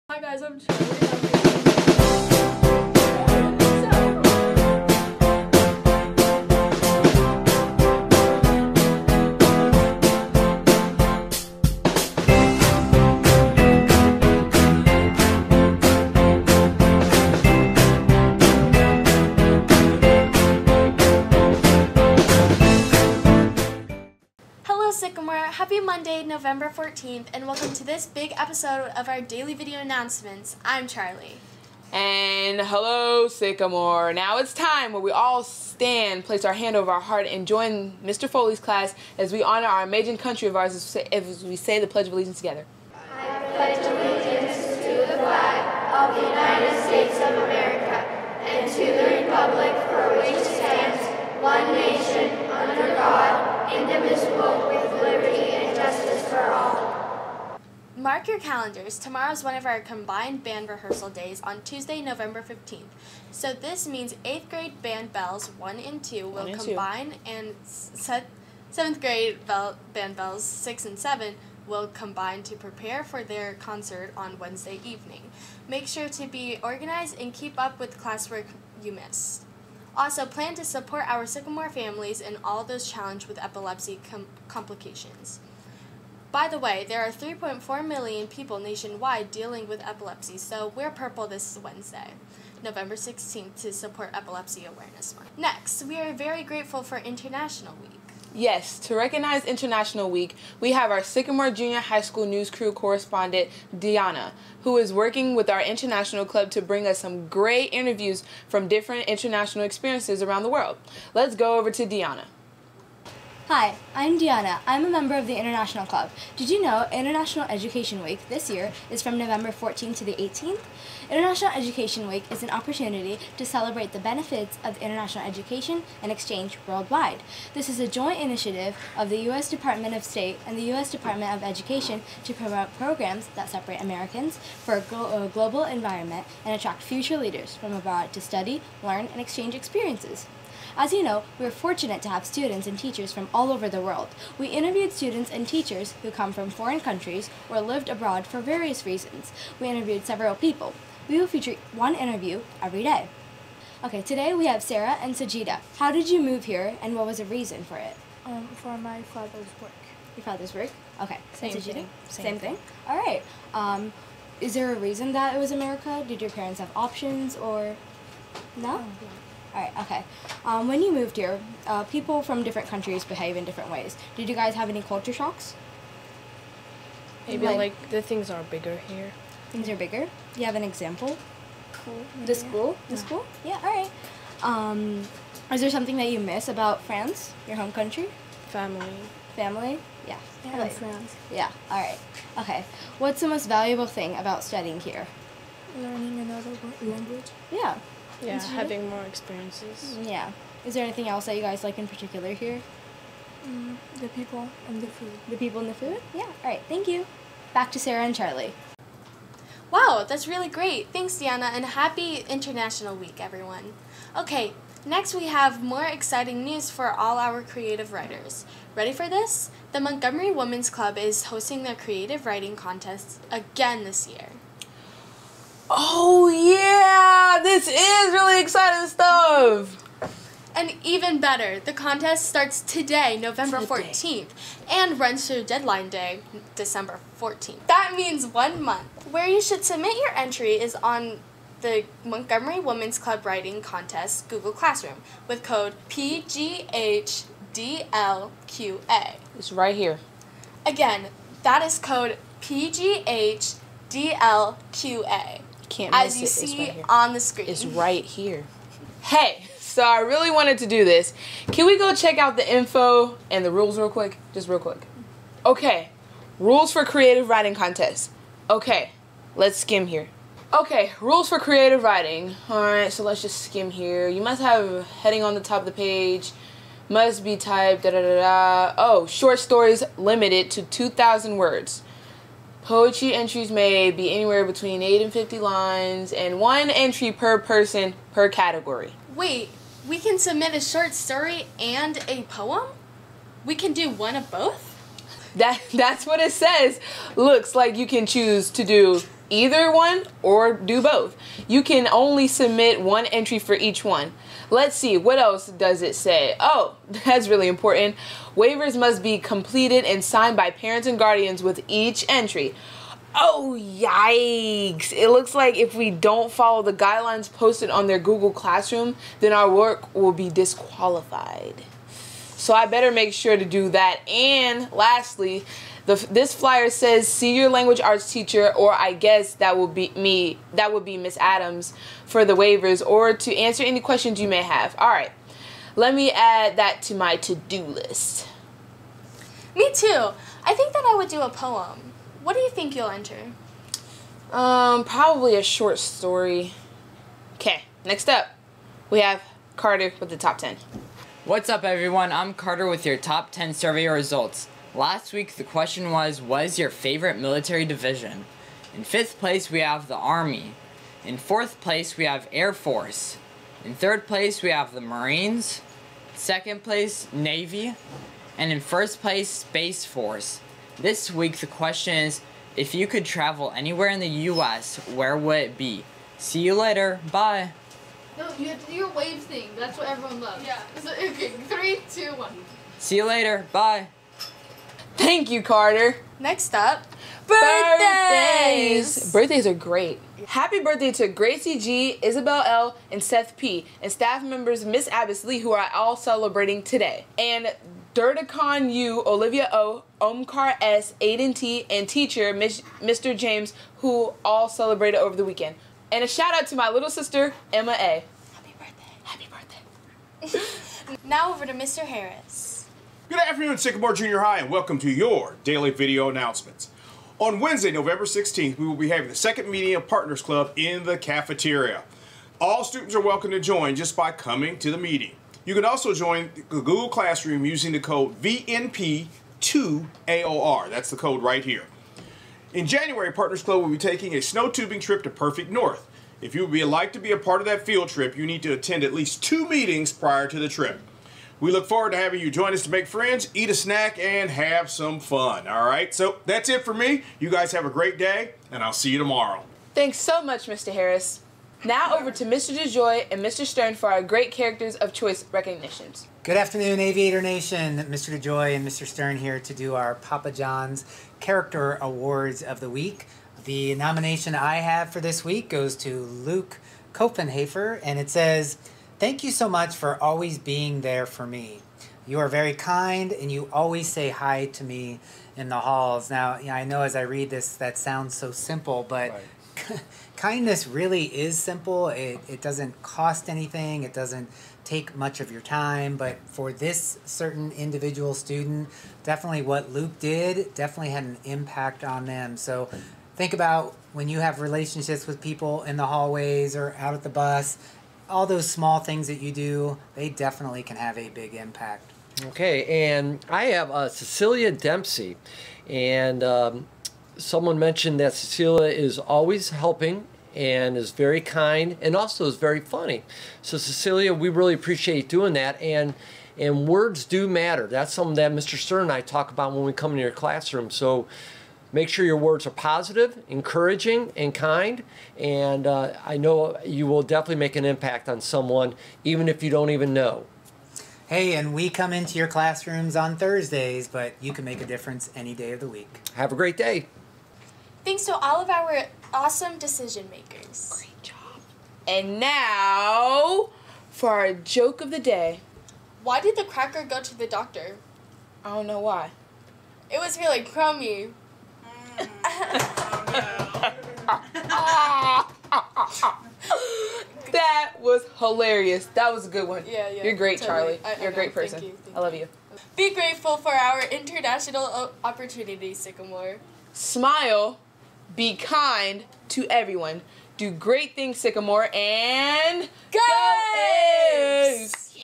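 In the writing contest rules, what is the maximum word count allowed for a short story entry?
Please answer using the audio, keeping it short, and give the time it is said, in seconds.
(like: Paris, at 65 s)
2,000 words, at 280 s.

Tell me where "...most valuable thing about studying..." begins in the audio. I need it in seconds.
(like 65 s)
193 s.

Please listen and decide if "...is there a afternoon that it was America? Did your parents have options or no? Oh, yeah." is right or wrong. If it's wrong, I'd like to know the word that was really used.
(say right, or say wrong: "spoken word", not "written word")
wrong: "reason", not "afternoon".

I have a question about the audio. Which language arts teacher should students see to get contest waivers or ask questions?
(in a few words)
Miss Adams.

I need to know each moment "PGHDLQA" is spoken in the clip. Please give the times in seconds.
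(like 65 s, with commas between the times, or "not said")
245 s, 252 s.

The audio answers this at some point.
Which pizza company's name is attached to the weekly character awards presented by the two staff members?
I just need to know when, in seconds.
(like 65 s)
459 s.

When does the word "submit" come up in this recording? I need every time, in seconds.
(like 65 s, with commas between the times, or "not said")
239 s, 290 s, 302 s.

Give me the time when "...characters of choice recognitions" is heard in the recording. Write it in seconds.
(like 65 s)
454 s.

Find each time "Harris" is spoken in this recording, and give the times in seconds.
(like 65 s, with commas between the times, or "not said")
411 s, 450 s.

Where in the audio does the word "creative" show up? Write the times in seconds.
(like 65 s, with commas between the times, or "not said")
217 s, 221 s, 266 s, 271 s.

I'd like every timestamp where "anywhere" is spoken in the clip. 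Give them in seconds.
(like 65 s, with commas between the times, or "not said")
284 s, 373 s.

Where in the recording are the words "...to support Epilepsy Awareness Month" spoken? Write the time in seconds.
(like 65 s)
93 s.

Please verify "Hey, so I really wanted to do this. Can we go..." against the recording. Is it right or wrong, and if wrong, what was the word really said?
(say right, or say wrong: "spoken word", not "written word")
right.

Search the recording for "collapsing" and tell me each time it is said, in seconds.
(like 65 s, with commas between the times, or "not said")
not said.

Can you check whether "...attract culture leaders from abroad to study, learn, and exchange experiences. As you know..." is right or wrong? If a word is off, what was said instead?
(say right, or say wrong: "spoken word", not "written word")
wrong: "future", not "culture".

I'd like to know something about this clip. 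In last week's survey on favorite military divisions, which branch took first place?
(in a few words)
Space Force.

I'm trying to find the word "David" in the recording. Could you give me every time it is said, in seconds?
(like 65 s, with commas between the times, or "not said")
not said.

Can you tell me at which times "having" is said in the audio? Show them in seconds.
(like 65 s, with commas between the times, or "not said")
198 s, 418 s, 441 s.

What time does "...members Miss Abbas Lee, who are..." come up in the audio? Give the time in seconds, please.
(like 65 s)
394 s.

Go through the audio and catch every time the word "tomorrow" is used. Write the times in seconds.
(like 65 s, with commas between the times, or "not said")
58 s, 448 s.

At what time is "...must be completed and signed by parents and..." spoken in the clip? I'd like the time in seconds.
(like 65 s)
308 s.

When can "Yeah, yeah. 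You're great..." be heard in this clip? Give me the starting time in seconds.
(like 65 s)
559 s.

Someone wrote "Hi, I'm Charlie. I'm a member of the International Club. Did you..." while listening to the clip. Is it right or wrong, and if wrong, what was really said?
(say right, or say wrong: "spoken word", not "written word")
wrong: "Deanna", not "Charlie".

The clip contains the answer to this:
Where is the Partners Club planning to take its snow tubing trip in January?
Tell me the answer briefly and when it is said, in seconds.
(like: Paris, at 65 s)
Perfect North, at 435 s.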